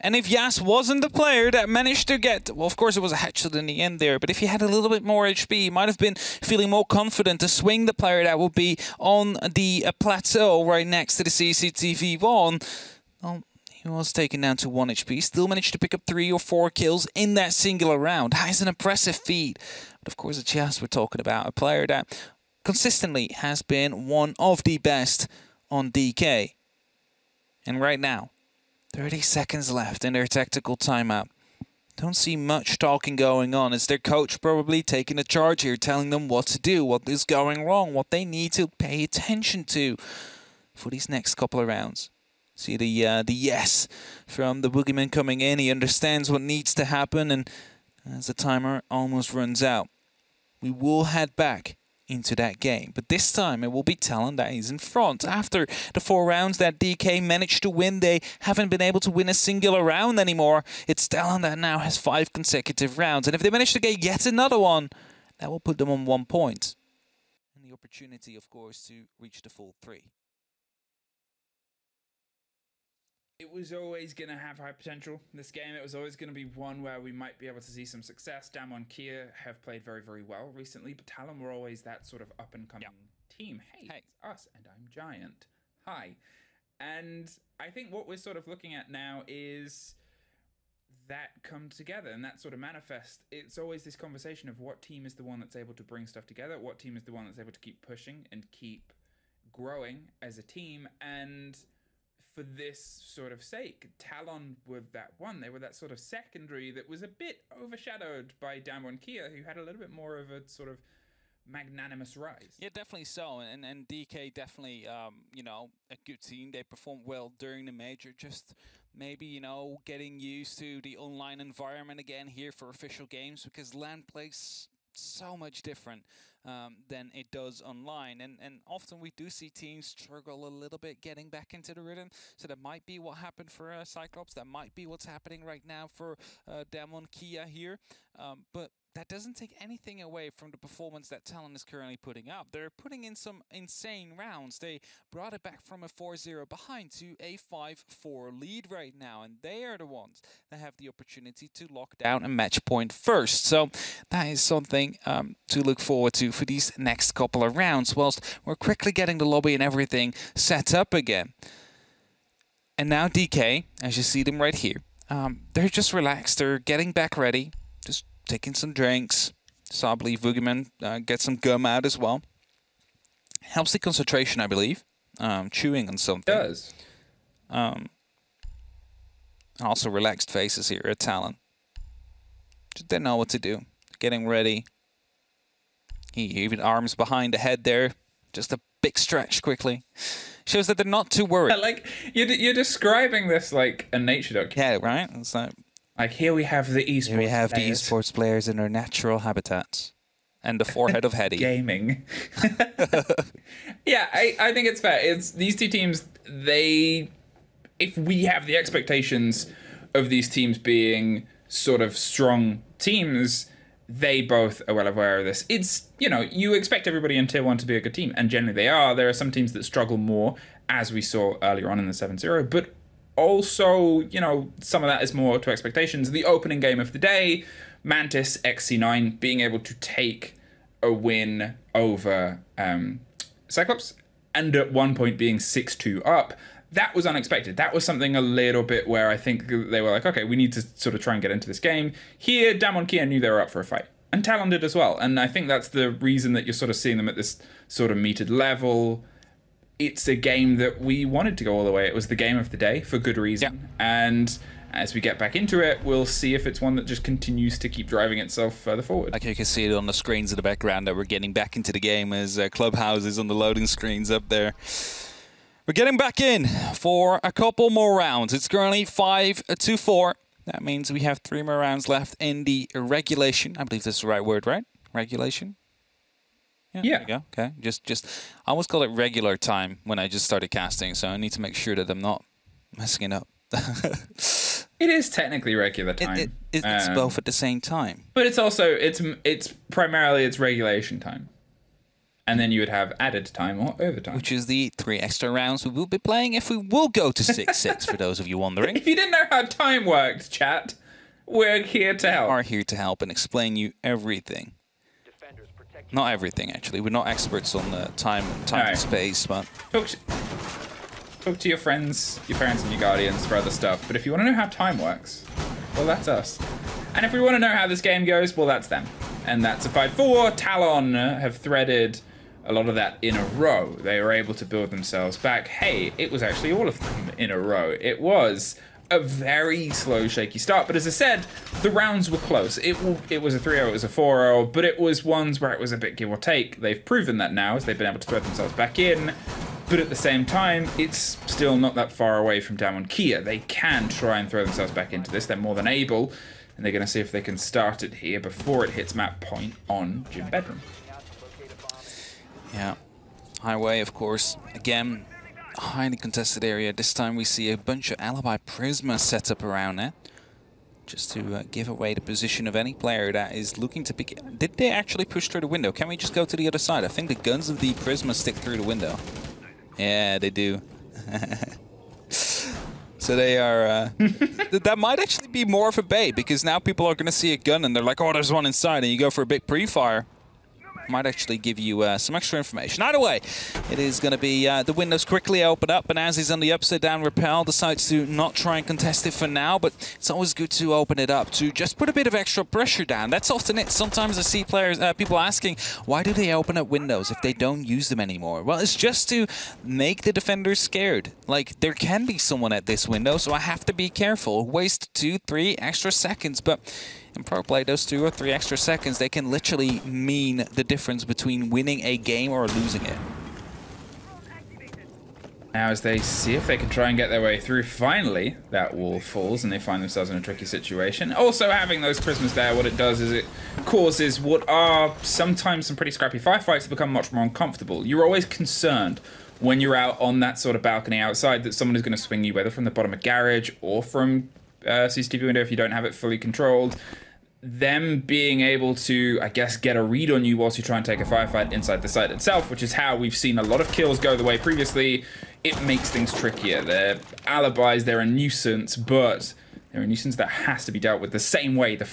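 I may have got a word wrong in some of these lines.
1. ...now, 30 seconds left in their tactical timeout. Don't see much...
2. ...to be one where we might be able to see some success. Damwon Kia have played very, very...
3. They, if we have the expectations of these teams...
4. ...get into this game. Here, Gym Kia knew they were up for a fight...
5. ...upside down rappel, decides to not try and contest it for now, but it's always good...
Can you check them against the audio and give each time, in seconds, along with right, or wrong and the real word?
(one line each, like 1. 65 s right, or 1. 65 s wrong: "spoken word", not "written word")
1. 27 s right
2. 76 s right
3. 206 s right
4. 241 s wrong: "Damwon", not "Gym"
5. 386 s right.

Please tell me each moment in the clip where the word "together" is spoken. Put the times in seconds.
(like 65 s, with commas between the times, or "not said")
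91 s, 96 s.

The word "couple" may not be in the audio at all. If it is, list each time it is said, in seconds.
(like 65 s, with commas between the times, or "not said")
41 s, 157 s, 267 s.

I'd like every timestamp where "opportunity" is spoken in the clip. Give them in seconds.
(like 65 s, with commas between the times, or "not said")
67 s, 150 s.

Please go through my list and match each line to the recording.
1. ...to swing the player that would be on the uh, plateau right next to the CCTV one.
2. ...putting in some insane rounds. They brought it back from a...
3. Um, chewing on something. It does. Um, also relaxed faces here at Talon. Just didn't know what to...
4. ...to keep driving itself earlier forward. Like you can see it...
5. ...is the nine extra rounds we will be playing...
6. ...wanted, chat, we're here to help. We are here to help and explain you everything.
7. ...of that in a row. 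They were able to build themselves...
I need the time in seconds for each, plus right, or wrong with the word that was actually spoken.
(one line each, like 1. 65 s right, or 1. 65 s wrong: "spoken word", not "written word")
1. 7 s right
2. 142 s right
3. 175 s right
4. 257 s wrong: "further", not "earlier"
5. 294 s wrong: "three", not "nine"
6. 299 s wrong: "worked", not "wanted"
7. 322 s right.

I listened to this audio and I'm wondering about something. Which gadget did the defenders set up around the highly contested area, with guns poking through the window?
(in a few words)
Alibi Prisma.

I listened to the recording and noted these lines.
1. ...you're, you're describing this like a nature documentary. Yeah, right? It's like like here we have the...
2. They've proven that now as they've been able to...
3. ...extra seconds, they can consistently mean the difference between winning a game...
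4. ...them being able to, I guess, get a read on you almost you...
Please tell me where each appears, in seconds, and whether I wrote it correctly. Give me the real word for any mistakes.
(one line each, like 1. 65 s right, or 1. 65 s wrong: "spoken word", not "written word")
1. 192 s right
2. 336 s right
3. 408 s wrong: "literally", not "consistently"
4. 437 s wrong: "whilst", not "almost".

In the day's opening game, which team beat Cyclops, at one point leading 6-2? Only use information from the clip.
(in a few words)
Mantis XC9.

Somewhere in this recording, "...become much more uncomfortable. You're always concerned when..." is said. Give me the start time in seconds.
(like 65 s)
426 s.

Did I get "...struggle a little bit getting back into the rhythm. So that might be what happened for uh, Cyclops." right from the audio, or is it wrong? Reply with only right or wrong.
right.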